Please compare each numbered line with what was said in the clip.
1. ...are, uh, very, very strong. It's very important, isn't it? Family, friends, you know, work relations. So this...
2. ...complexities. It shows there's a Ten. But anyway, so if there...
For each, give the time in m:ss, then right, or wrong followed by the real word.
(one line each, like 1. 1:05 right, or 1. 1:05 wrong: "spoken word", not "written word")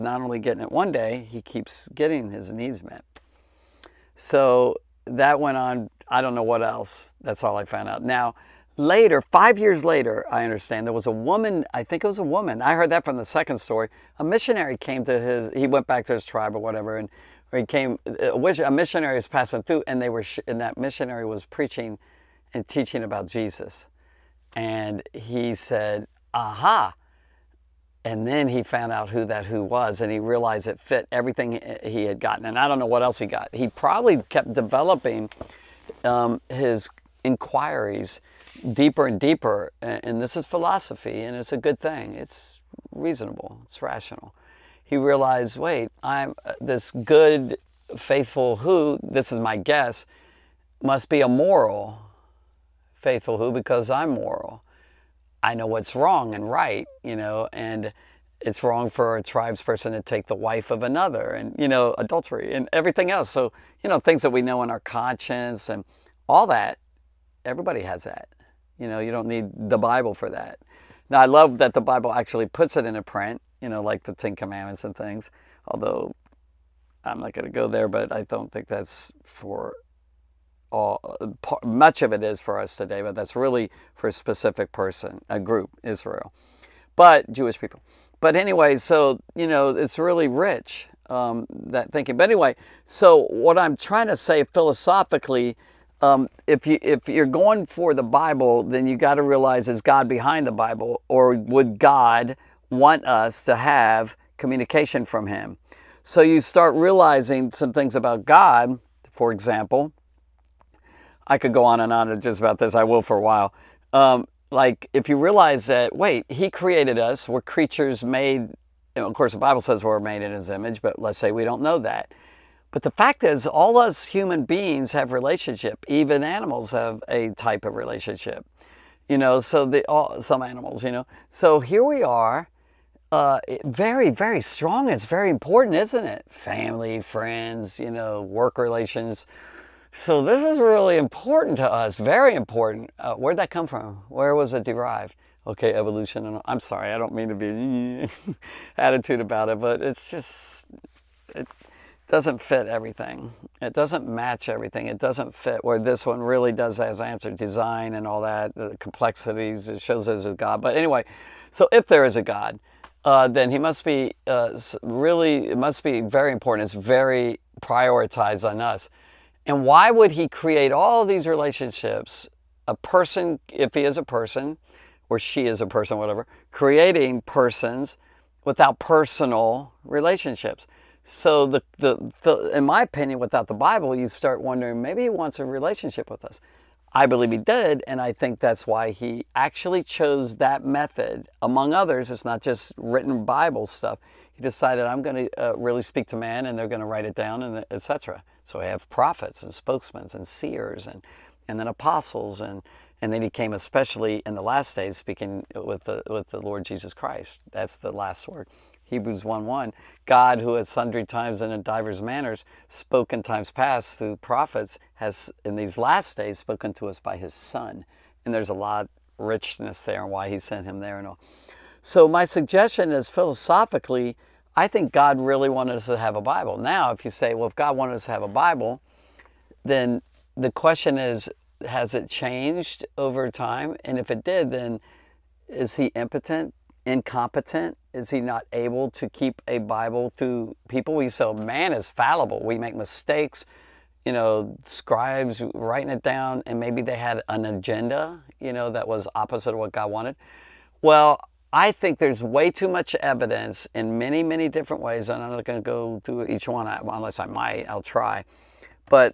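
1. 2:12 right
2. 2:38 wrong: "God", not "Ten".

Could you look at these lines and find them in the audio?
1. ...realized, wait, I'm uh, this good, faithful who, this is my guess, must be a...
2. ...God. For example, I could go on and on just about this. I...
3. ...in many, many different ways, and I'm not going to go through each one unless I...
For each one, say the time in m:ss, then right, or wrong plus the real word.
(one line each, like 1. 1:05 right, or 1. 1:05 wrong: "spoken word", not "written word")
1. 0:44 right
2. 1:48 right
3. 4:13 right.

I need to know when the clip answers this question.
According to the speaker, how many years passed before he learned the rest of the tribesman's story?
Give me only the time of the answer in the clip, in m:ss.
0:09.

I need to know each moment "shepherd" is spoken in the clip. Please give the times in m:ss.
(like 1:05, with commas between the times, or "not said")
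not said.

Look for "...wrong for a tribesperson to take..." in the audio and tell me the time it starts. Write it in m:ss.
0:58.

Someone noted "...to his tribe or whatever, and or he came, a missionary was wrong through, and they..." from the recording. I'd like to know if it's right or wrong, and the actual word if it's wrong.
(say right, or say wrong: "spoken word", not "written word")
wrong: "passing", not "wrong".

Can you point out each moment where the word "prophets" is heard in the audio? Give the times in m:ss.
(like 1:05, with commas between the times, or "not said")
3:18, 3:34.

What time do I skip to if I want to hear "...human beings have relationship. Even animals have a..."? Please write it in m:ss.
2:04.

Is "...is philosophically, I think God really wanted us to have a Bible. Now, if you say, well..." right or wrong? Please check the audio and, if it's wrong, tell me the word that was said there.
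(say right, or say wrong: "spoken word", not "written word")
right.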